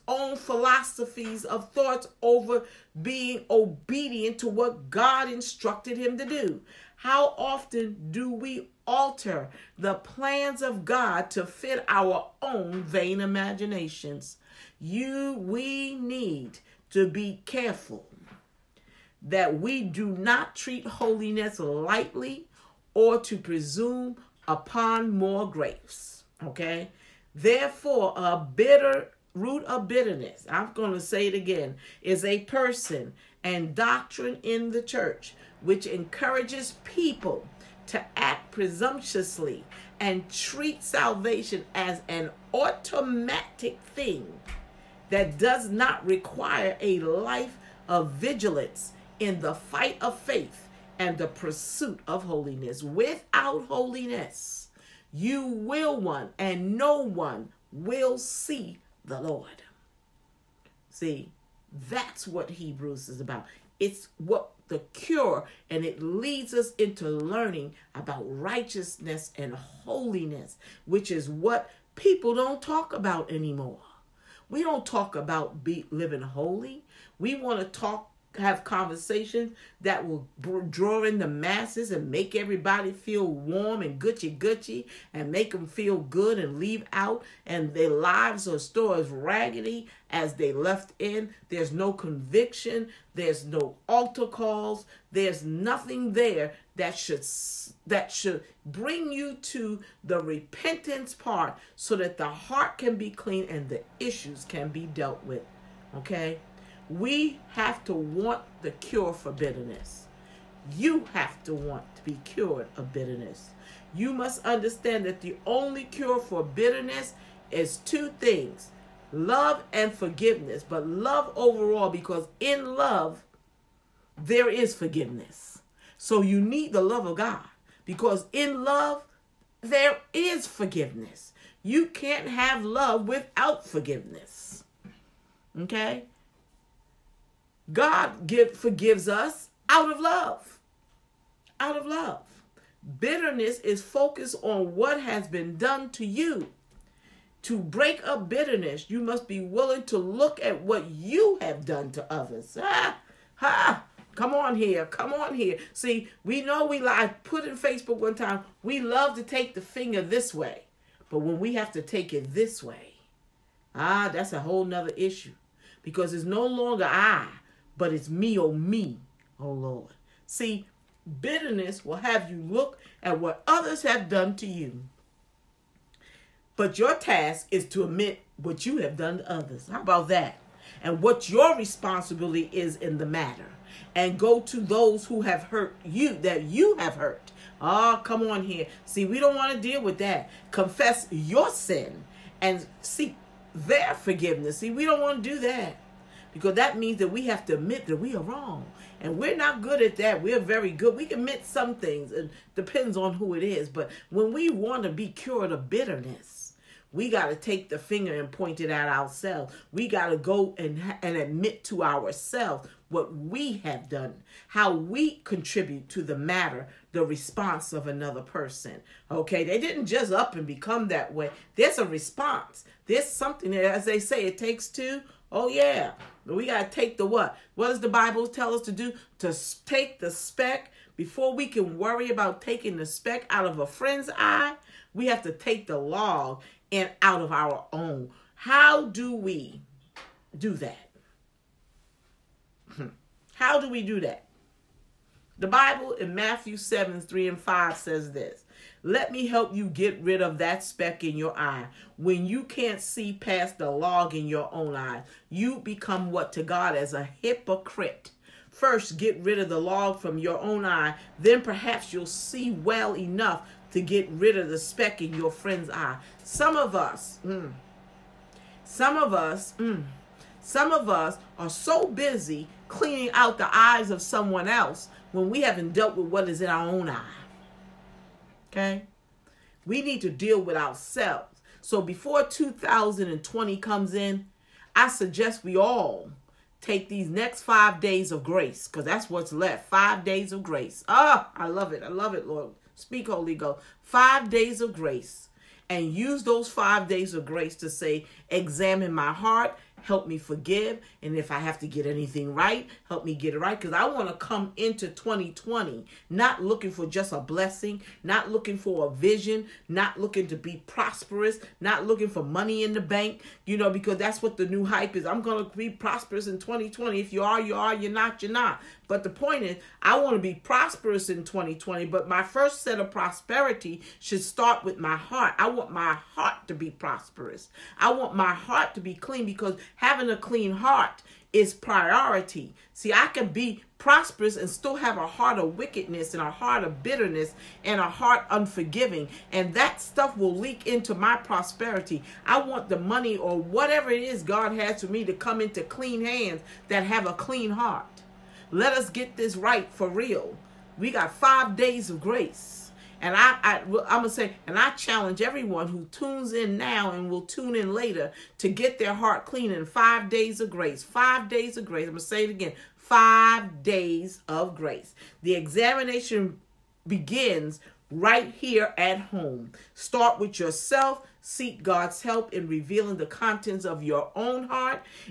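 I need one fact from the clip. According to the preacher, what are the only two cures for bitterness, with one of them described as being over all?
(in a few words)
Love and forgiveness.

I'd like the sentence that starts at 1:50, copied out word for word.
You have to want to be cured of bitterness.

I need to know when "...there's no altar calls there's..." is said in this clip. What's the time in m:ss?
1:33.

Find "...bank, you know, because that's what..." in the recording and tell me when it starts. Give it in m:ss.
5:12.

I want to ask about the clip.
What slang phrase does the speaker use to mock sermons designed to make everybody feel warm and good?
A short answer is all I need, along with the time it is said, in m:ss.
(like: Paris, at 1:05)
gucci gucci, at 1:24.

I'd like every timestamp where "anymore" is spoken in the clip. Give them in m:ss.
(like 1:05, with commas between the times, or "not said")
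1:13.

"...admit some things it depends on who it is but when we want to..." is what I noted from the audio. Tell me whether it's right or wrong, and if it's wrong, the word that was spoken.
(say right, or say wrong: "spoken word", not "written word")
right.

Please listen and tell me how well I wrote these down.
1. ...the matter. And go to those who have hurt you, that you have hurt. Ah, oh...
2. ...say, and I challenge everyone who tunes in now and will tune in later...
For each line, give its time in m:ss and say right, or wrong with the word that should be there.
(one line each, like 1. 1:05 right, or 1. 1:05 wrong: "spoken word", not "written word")
1. 3:02 right
2. 5:54 right.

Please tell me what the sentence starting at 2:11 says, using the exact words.
You can't have love without forgiveness.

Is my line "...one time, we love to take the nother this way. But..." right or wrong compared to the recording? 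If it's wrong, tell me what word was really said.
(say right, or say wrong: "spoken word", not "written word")
wrong: "finger", not "nother".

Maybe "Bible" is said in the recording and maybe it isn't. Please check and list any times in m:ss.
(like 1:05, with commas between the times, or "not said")
3:47, 4:05.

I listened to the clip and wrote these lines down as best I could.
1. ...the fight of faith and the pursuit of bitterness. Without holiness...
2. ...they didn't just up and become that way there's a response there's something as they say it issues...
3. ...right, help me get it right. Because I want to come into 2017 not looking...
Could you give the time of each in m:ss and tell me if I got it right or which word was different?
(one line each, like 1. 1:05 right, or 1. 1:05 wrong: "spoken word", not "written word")
1. 0:49 wrong: "holiness", not "bitterness"
2. 3:39 wrong: "takes", not "issues"
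3. 5:02 wrong: "2020", not "2017".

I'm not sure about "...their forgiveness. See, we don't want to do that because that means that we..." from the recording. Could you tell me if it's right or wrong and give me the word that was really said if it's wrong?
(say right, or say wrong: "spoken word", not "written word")
right.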